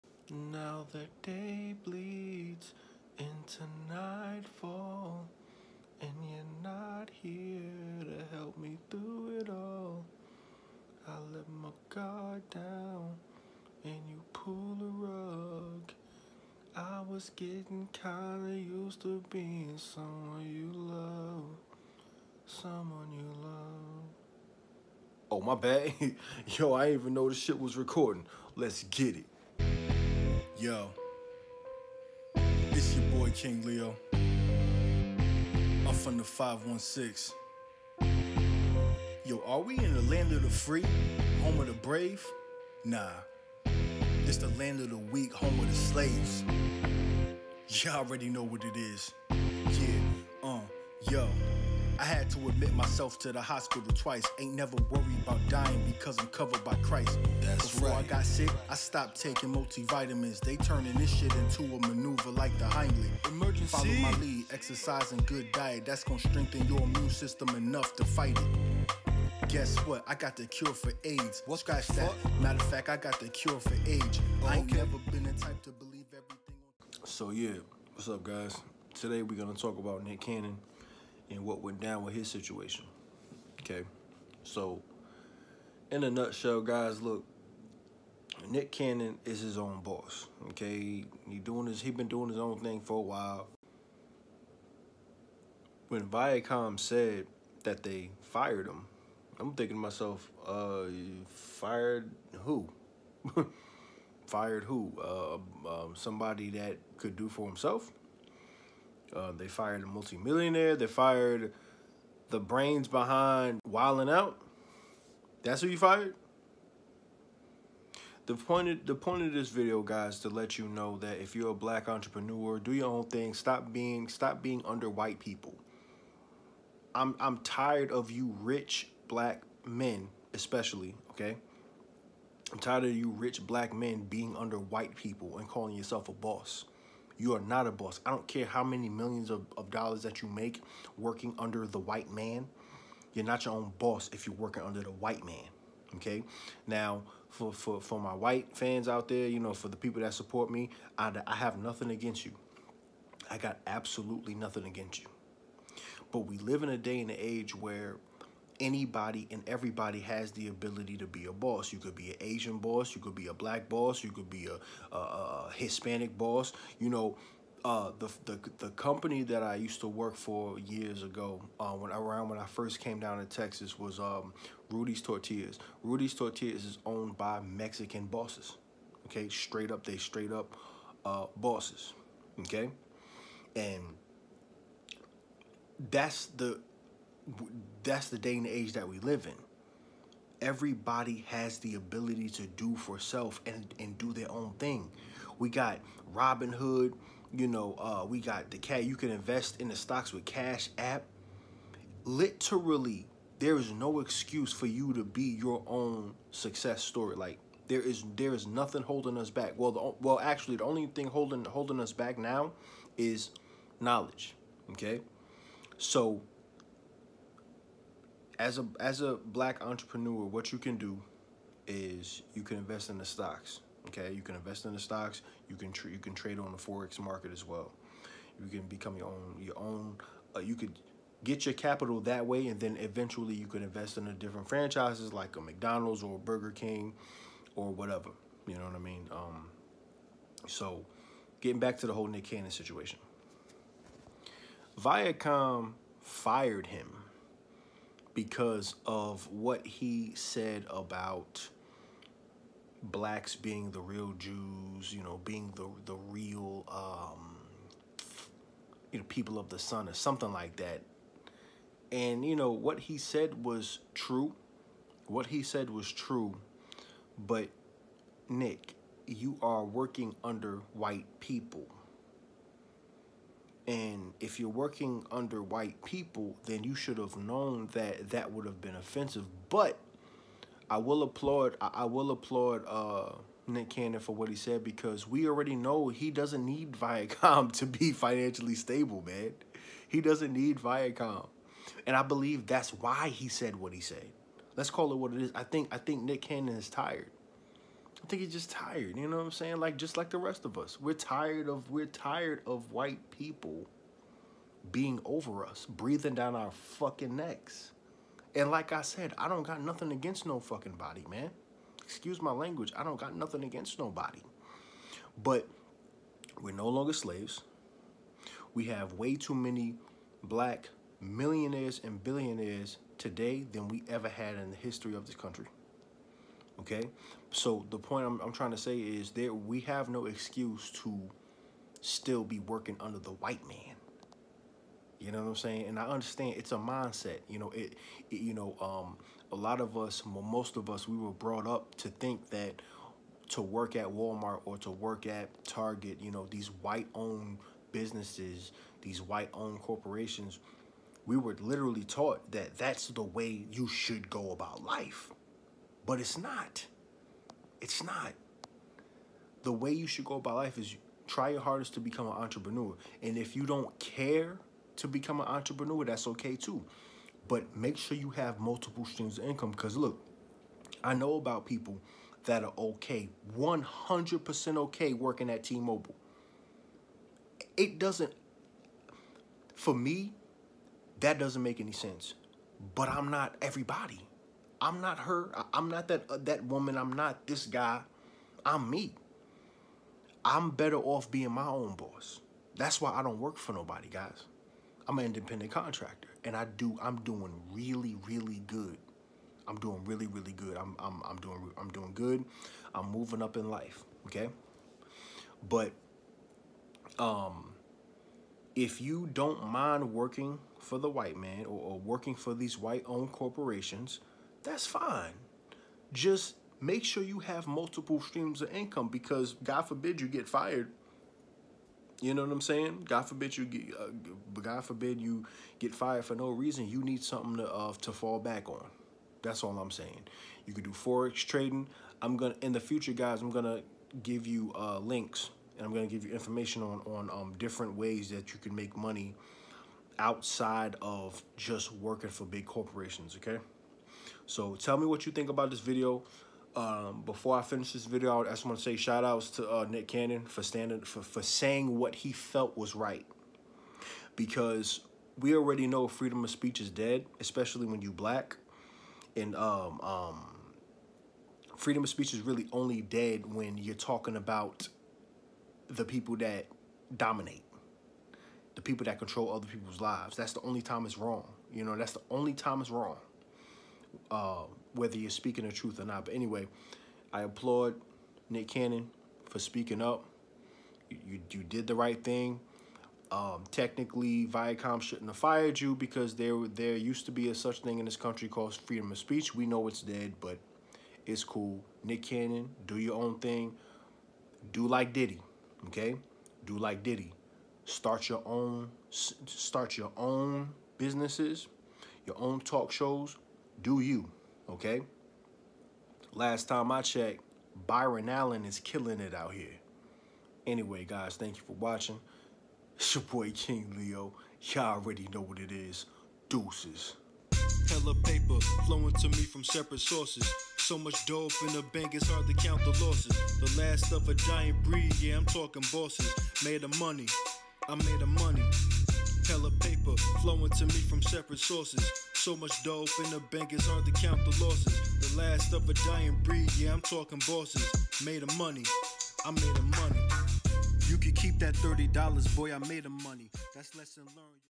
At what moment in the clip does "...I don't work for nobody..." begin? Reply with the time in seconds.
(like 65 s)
392 s.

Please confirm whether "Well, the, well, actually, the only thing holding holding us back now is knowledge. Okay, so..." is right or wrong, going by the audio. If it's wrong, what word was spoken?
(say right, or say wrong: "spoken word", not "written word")
right.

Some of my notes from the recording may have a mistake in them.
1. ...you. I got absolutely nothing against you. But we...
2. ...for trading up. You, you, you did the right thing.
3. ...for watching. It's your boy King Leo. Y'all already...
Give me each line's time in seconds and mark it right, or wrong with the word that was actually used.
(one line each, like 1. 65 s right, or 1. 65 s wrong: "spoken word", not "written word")
1. 152 s right
2. 479 s wrong: "speaking", not "trading"
3. 511 s right.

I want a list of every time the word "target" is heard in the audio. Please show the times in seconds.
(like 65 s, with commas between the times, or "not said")
345 s.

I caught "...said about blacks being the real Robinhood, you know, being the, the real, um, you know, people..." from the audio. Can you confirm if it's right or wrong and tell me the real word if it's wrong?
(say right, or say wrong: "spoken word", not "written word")
wrong: "Jews", not "Robinhood".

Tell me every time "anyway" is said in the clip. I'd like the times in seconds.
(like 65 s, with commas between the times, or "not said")
476 s, 510 s.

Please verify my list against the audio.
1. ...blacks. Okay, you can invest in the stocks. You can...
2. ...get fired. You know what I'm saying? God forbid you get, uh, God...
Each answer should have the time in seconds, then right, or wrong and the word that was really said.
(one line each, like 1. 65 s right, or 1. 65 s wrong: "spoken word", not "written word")
1. 223 s wrong: "stocks", not "blacks"
2. 420 s right.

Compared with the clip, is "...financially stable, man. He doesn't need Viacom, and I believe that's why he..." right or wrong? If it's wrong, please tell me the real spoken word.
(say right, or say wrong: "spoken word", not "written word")
right.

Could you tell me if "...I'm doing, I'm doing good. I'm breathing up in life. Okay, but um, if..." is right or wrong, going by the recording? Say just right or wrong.
wrong.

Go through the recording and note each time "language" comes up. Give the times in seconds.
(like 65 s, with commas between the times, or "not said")
312 s.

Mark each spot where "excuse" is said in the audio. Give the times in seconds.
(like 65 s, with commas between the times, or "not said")
203 s, 311 s, 330 s.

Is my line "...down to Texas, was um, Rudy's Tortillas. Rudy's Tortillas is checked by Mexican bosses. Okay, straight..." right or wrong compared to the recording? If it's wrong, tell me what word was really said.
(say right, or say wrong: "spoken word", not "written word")
wrong: "owned", not "checked".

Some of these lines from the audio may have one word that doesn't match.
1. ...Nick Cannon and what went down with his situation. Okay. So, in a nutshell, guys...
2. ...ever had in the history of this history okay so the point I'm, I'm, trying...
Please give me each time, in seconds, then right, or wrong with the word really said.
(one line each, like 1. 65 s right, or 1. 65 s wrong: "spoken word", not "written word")
1. 80 s right
2. 323 s wrong: "country", not "history".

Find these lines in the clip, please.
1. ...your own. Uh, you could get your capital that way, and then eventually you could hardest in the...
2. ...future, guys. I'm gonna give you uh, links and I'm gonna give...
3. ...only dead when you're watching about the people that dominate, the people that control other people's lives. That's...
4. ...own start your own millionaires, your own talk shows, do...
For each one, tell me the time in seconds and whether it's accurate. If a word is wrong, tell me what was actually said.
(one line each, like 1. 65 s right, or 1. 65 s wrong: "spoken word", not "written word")
1. 229 s wrong: "invest", not "hardest"
2. 432 s right
3. 462 s wrong: "talking", not "watching"
4. 498 s wrong: "businesses", not "millionaires".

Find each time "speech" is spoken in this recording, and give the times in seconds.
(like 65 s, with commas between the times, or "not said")
456 s, 461 s, 488 s.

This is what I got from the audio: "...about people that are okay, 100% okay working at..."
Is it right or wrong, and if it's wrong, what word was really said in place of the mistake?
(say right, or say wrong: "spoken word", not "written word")
right.